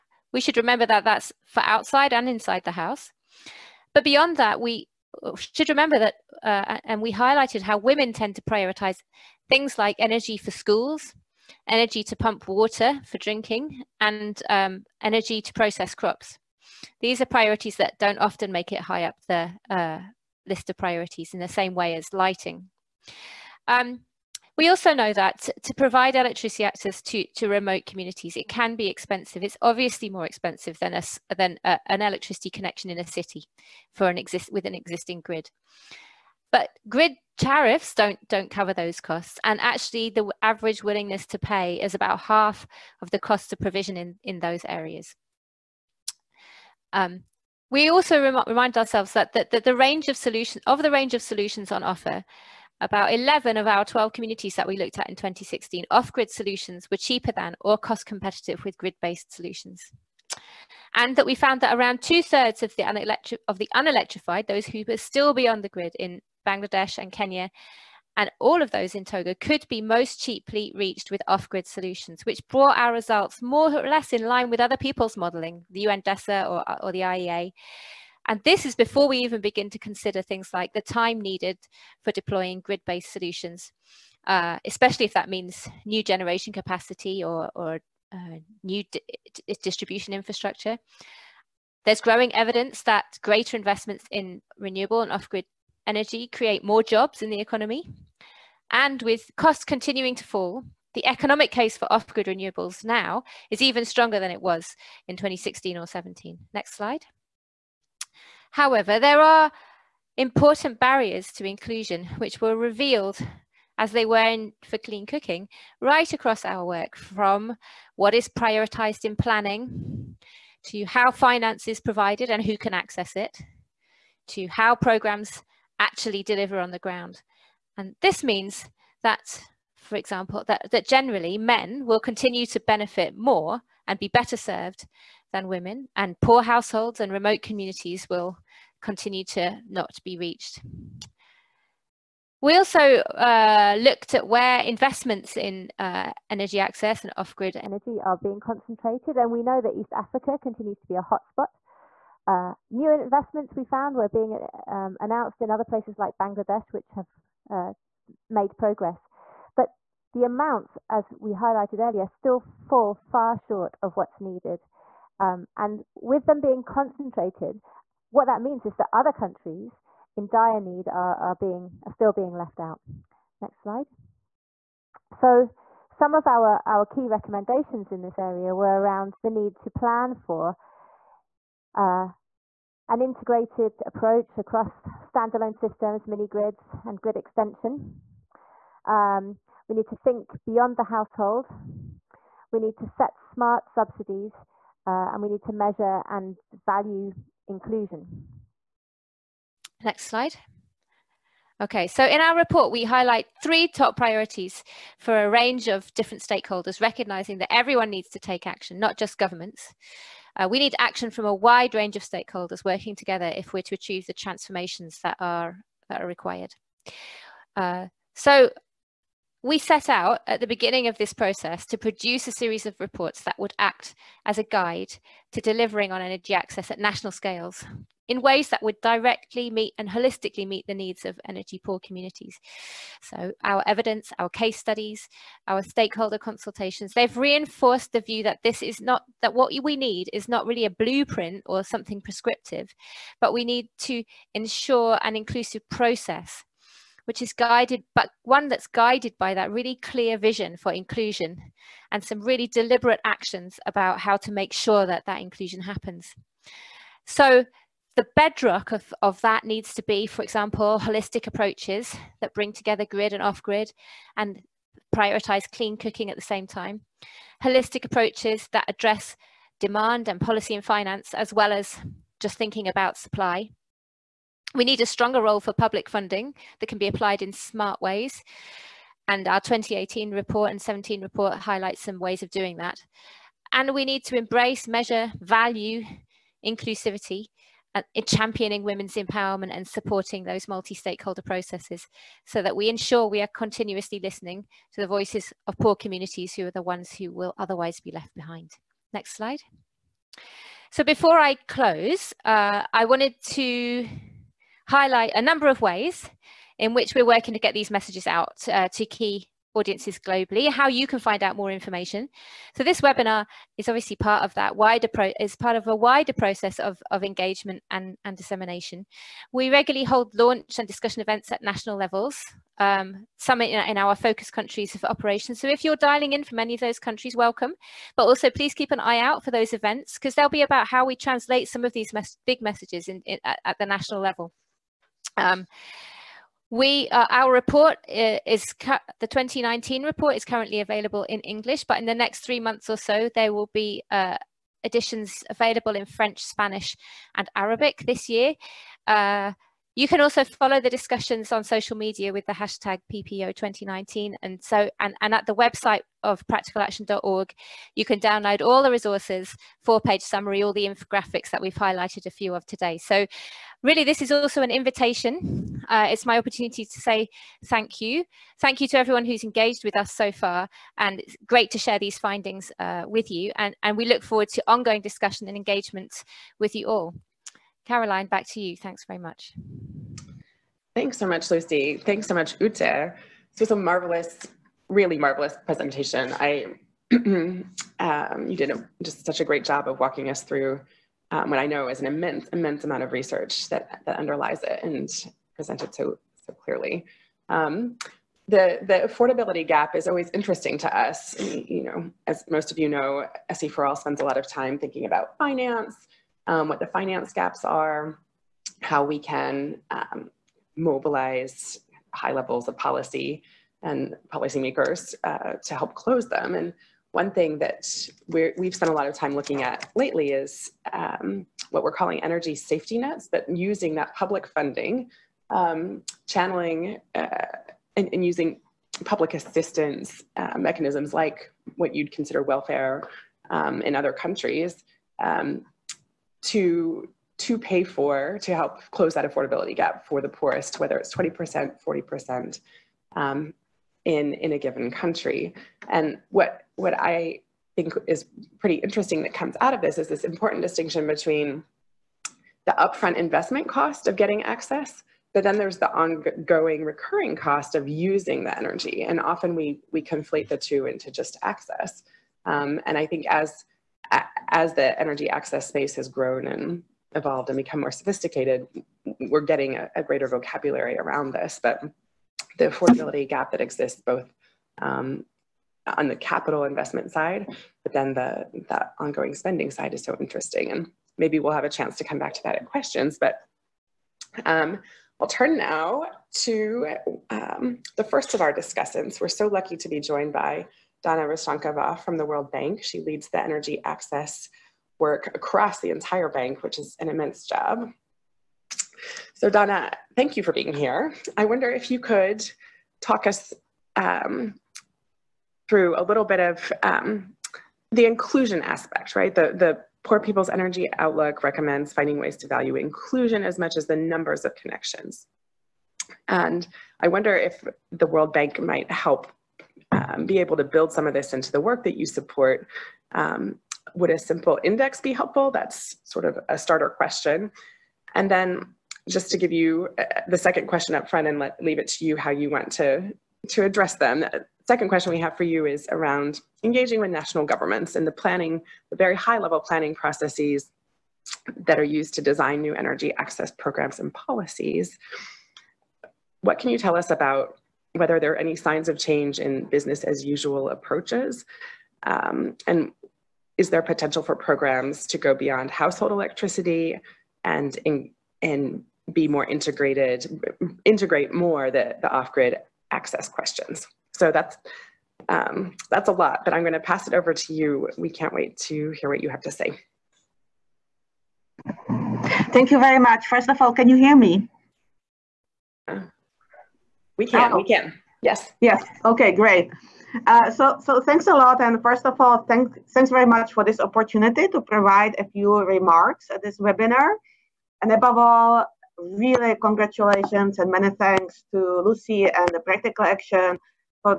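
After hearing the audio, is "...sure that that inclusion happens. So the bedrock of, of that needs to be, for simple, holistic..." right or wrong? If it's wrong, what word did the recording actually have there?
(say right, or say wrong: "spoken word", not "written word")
wrong: "example", not "simple".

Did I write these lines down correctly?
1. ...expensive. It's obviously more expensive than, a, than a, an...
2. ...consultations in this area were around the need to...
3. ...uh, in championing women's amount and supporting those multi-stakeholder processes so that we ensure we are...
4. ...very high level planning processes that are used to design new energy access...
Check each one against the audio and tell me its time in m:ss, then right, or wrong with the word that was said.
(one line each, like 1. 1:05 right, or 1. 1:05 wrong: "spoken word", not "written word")
1. 0:28 right
2. 2:57 wrong: "recommendations", not "consultations"
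3. 4:47 wrong: "empowerment", not "amount"
4. 8:58 right.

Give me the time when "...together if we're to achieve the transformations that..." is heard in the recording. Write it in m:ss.
3:32.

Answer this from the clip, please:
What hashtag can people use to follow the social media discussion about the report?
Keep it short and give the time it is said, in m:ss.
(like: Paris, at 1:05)
PPO2019, at 5:52.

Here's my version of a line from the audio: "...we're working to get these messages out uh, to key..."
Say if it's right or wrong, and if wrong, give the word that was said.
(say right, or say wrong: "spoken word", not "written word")
right.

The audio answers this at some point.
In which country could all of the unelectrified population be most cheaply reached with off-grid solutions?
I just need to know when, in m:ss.
1:09.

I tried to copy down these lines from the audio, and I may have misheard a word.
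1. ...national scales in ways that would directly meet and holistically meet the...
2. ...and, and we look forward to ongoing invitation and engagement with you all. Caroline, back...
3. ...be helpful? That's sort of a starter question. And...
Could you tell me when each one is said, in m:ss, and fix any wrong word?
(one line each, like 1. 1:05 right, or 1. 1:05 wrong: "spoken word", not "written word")
1. 3:46 right
2. 6:13 wrong: "discussion", not "invitation"
3. 8:44 right.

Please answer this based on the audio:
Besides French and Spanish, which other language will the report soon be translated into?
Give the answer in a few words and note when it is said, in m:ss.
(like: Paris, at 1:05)
Arabic, at 5:47.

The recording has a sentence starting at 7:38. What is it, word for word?
And often we we conflate the two into just access.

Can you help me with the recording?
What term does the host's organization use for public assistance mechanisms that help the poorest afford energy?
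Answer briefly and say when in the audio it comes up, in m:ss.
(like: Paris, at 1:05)
energy safety nets, at 7:02.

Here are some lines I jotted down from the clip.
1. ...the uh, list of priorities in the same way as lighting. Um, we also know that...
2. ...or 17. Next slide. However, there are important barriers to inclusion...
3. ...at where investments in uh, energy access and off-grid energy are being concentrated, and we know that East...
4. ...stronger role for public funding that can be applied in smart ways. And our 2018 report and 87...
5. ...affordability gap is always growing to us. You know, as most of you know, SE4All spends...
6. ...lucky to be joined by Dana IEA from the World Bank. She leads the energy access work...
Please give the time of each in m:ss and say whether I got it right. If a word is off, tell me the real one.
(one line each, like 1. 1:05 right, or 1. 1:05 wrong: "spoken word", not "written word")
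1. 0:19 right
2. 1:45 right
3. 2:24 right
4. 4:34 wrong: "17", not "87"
5. 6:38 wrong: "interesting", not "growing"
6. 8:09 wrong: "Rysankova", not "IEA".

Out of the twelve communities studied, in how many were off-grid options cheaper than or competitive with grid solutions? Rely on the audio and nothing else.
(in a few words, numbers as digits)
11.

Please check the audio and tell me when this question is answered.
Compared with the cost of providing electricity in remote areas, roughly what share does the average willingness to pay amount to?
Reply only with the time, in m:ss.
0:41.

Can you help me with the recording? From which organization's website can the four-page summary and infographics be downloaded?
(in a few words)
Practical Action.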